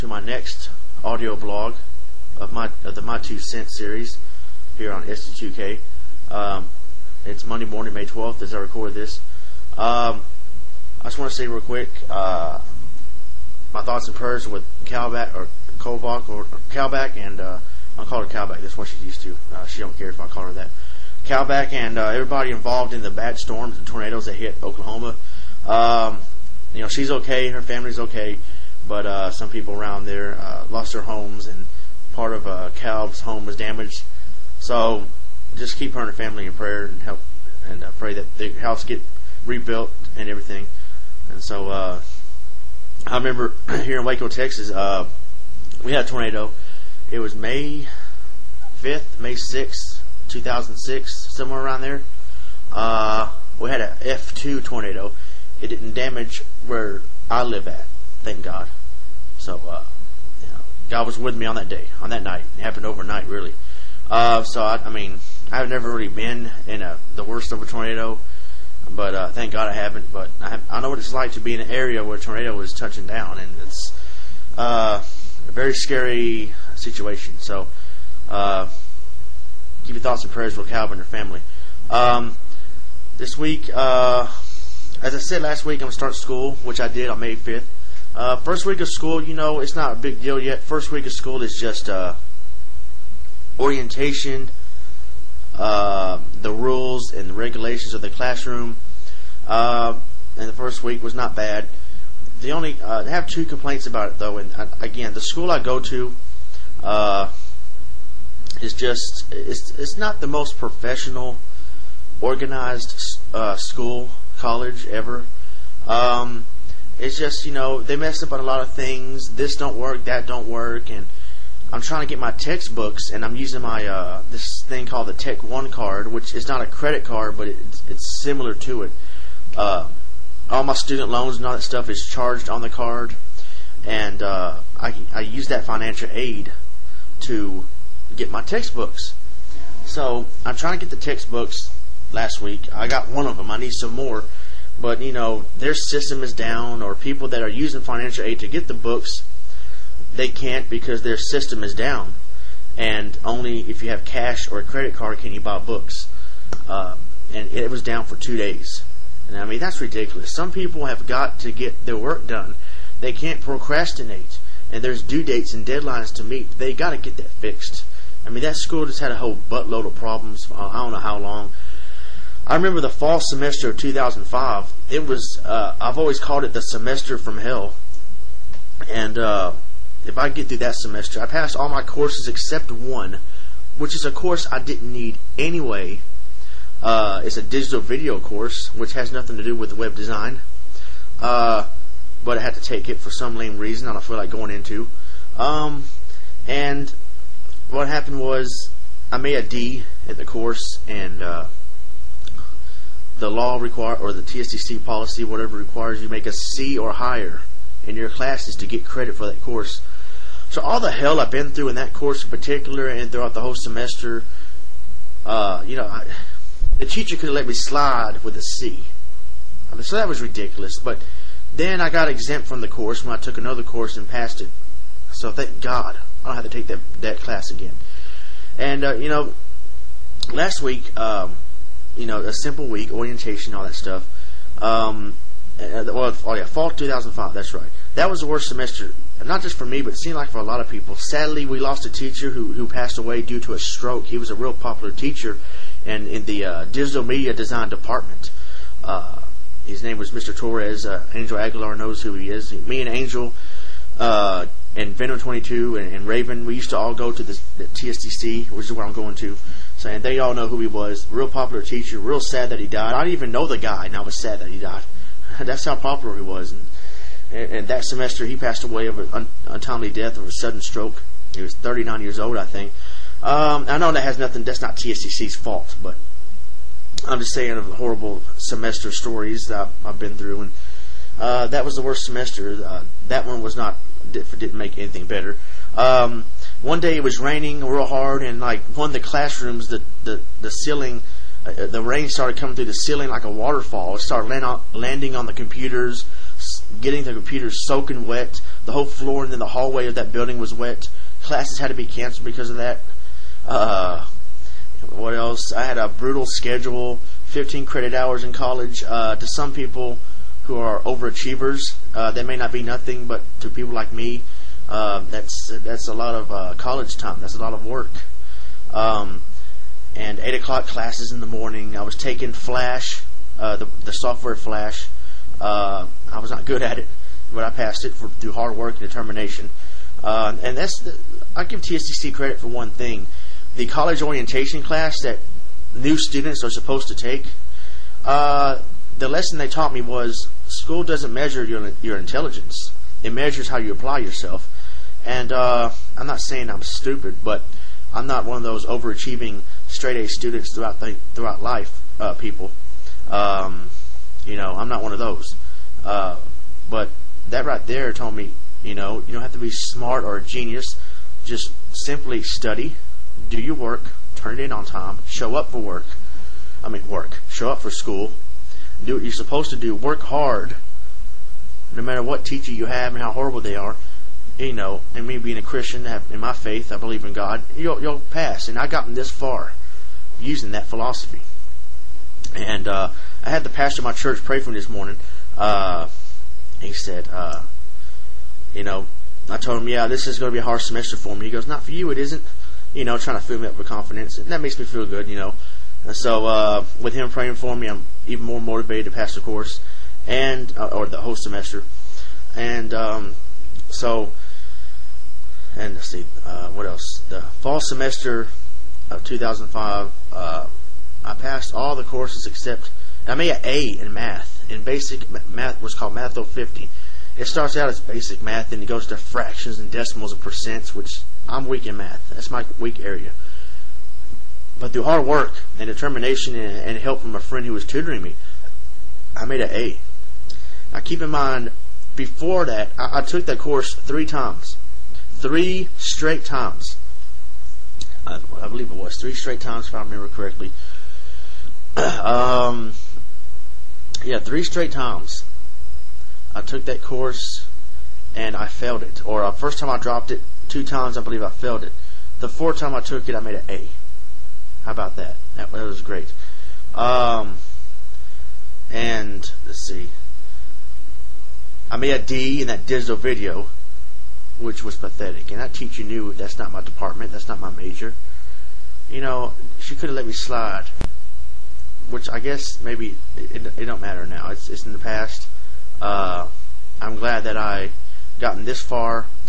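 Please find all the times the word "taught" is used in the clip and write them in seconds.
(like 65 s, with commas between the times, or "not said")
339 s.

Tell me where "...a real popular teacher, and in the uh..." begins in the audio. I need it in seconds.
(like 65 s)
244 s.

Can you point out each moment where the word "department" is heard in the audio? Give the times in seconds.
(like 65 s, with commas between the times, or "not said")
247 s, 466 s.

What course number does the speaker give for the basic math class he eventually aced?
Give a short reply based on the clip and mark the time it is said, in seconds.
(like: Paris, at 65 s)
Math 050, at 415 s.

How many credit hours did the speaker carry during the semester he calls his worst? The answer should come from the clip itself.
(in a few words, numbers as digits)
15.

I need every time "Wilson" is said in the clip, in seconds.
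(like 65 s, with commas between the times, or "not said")
not said.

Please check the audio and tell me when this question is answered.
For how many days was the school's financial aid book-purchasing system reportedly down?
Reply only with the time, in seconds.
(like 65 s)
158 s.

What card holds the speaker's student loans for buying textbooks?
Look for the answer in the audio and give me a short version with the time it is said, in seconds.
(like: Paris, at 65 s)
Tech One card, at 125 s.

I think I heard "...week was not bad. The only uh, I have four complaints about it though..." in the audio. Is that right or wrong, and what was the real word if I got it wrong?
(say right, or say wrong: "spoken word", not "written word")
wrong: "two", not "four".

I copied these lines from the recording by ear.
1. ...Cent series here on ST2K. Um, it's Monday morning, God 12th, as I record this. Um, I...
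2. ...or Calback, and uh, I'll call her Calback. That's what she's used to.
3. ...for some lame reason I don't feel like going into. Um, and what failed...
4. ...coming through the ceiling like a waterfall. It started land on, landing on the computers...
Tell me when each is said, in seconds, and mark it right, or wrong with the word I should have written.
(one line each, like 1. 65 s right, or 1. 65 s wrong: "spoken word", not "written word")
1. 3 s wrong: "May", not "God"
2. 16 s right
3. 192 s wrong: "happened", not "failed"
4. 292 s right.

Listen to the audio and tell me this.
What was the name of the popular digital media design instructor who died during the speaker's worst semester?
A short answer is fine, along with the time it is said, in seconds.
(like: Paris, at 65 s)
Mr. Torres, at 250 s.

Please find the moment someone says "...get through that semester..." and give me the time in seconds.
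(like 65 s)
180 s.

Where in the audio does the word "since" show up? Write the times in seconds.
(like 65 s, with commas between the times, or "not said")
not said.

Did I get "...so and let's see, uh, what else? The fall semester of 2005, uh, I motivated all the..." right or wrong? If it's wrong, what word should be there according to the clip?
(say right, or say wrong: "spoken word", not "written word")
wrong: "passed", not "motivated".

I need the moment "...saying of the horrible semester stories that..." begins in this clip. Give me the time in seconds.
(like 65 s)
277 s.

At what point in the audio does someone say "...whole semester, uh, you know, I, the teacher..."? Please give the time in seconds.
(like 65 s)
213 s.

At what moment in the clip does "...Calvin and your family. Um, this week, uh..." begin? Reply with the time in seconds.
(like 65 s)
80 s.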